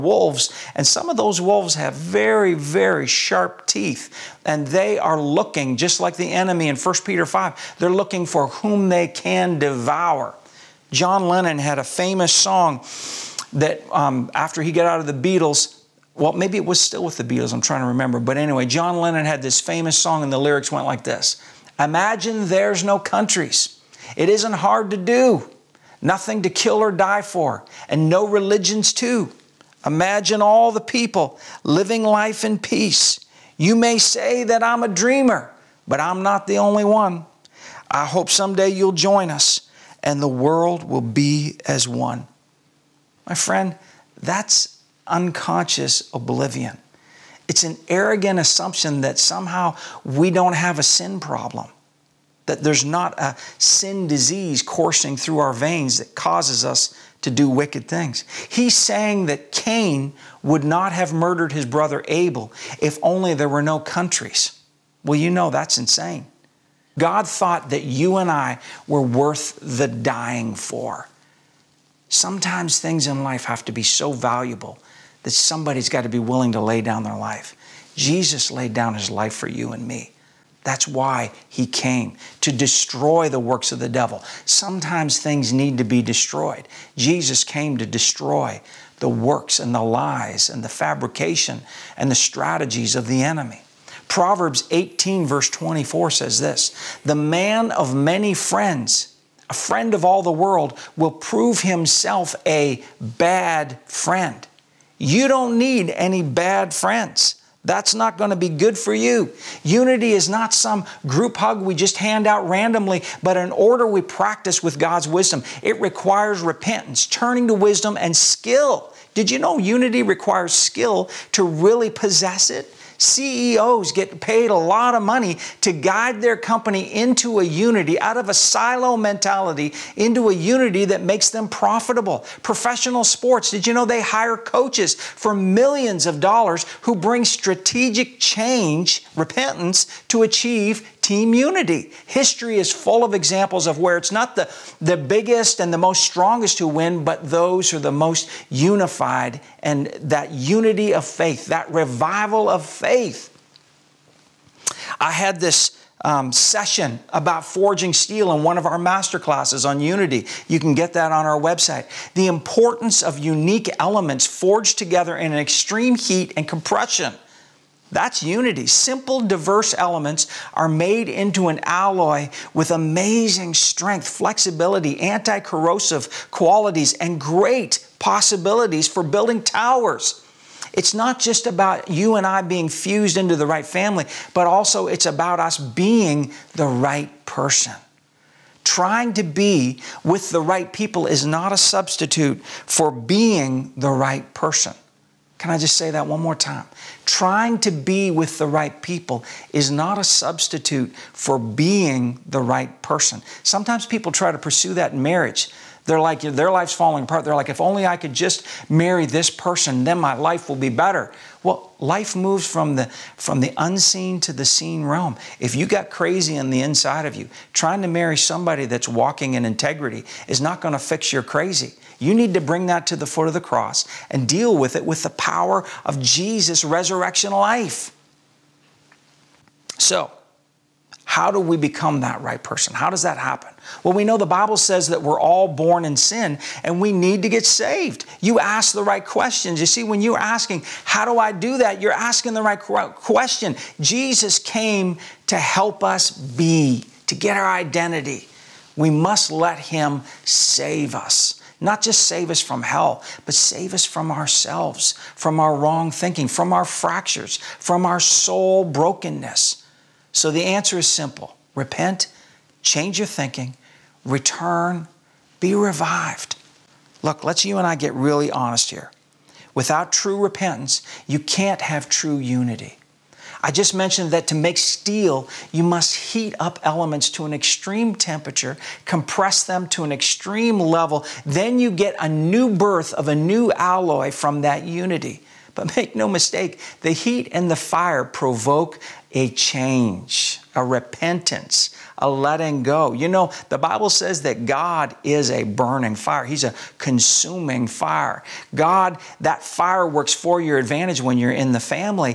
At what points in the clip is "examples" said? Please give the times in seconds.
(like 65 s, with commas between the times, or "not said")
143 s.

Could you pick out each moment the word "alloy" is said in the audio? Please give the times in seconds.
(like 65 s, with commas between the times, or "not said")
171 s, 283 s.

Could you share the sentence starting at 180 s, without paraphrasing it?
It's not just about you and I being fused into the right family, but also it's about us being the right person.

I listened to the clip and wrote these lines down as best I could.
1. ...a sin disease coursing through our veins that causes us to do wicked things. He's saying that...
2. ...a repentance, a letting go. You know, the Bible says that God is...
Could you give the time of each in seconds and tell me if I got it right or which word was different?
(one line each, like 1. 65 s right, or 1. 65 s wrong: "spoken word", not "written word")
1. 53 s right
2. 290 s right.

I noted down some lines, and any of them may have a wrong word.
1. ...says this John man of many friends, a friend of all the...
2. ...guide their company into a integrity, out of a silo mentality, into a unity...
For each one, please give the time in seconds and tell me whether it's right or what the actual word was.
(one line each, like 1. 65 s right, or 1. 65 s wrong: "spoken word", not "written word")
1. 96 s wrong: "The", not "John"
2. 125 s wrong: "unity", not "integrity".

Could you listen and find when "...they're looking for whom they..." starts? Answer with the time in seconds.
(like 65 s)
7 s.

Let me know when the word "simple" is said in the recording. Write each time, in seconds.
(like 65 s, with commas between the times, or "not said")
168 s, 260 s.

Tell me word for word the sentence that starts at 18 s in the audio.
But anyway, John Lennon had this famous song, and the lyrics went like this Imagine there's no countries.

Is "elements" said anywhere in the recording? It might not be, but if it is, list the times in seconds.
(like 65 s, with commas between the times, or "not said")
163 s, 169 s, 276 s.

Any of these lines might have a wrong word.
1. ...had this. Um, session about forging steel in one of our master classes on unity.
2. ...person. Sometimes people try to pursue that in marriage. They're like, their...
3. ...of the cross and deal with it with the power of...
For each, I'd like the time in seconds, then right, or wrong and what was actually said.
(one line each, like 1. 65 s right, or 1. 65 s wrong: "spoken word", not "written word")
1. 155 s right
2. 202 s right
3. 223 s right.